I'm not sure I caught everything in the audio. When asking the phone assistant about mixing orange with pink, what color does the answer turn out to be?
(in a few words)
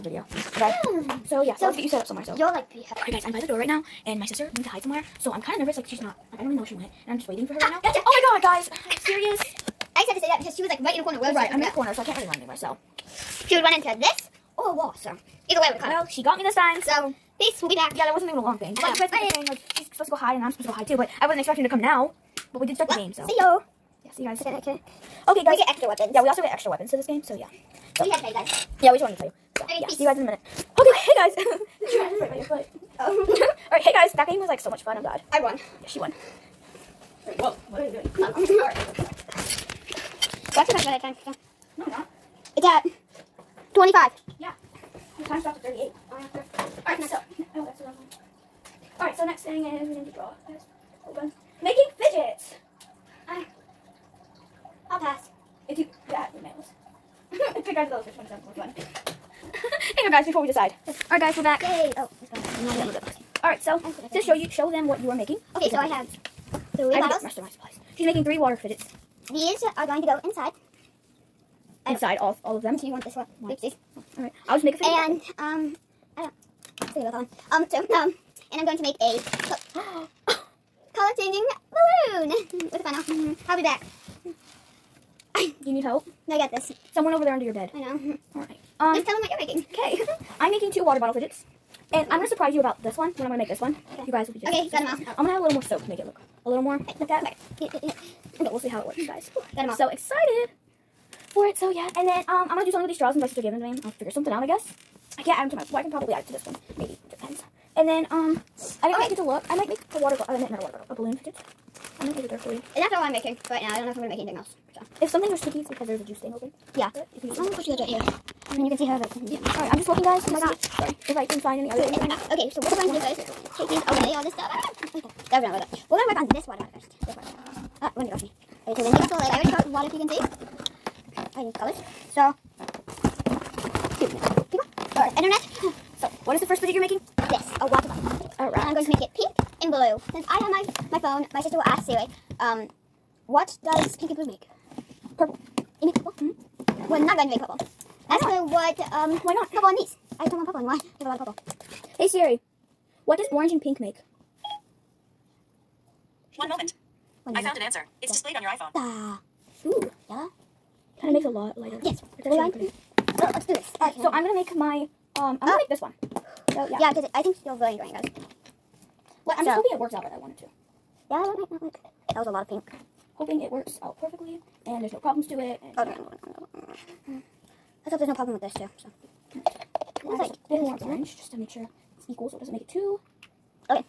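Yellow.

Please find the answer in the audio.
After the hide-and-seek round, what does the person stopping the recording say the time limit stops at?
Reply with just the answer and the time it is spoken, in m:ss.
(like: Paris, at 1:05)
38, at 0:45.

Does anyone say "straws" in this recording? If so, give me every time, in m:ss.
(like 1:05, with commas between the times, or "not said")
1:42.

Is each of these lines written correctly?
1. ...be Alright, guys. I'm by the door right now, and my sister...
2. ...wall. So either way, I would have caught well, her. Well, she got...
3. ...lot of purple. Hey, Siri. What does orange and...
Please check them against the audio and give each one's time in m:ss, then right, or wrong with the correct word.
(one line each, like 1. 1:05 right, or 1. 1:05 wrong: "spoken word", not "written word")
1. 0:02 right
2. 0:14 right
3. 2:31 right.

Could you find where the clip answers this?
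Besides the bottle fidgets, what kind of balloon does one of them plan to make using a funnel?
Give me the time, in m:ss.
1:20.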